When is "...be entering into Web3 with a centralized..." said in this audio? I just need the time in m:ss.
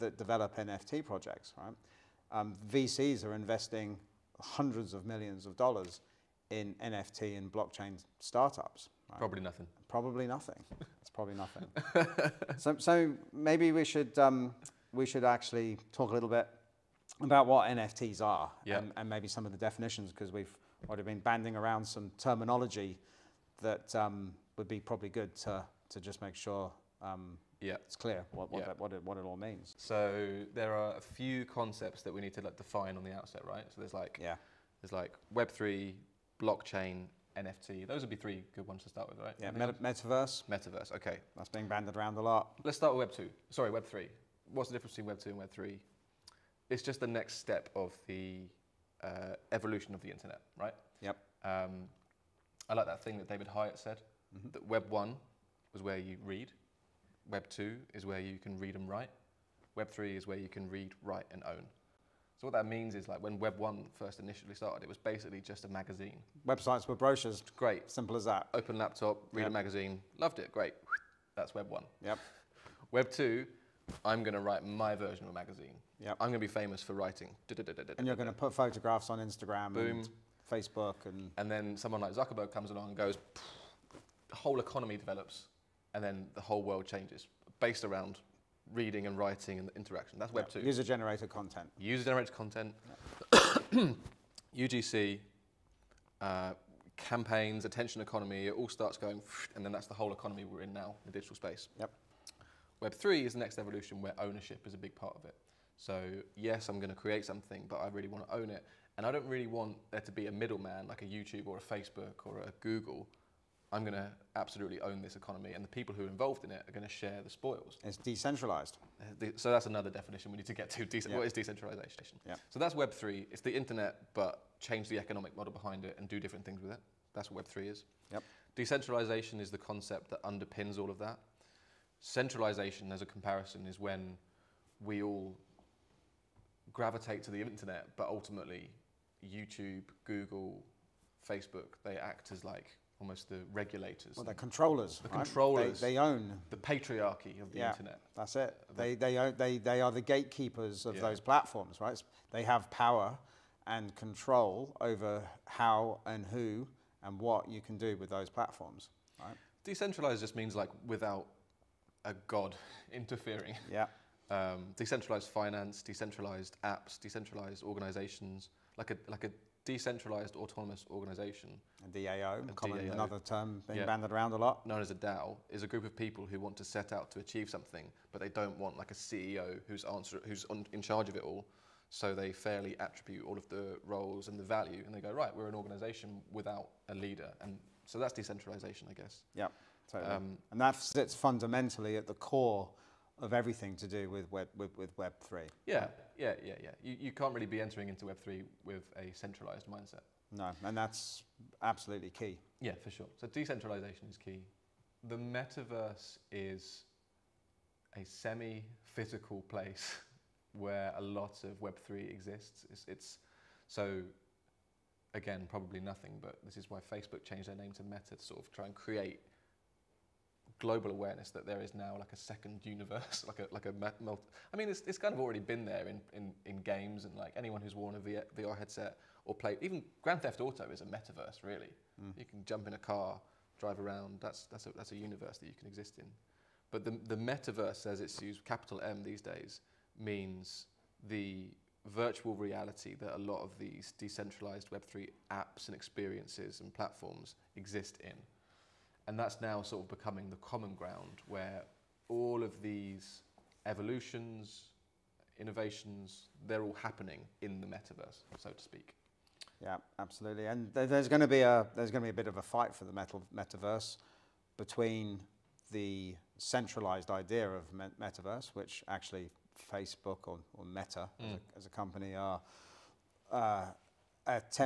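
3:17.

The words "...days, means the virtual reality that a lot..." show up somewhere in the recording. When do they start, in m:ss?
3:59.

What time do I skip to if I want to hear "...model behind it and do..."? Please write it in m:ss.
2:05.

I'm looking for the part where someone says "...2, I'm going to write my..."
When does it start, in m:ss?
1:13.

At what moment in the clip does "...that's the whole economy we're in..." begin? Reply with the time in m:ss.
1:39.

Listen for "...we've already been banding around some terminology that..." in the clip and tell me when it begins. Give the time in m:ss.
0:20.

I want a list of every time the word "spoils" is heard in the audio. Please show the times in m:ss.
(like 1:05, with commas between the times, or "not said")
1:57.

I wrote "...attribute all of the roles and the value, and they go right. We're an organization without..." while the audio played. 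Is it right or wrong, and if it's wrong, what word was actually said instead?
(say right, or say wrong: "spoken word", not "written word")
right.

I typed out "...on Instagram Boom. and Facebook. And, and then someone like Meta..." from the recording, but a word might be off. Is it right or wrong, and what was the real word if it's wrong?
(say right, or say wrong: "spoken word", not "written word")
wrong: "Zuckerberg", not "Meta".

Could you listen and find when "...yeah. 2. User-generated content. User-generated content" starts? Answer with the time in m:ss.
1:30.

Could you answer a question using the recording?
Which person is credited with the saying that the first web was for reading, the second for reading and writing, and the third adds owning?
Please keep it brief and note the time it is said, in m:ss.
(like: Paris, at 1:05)
David Hyatt, at 0:53.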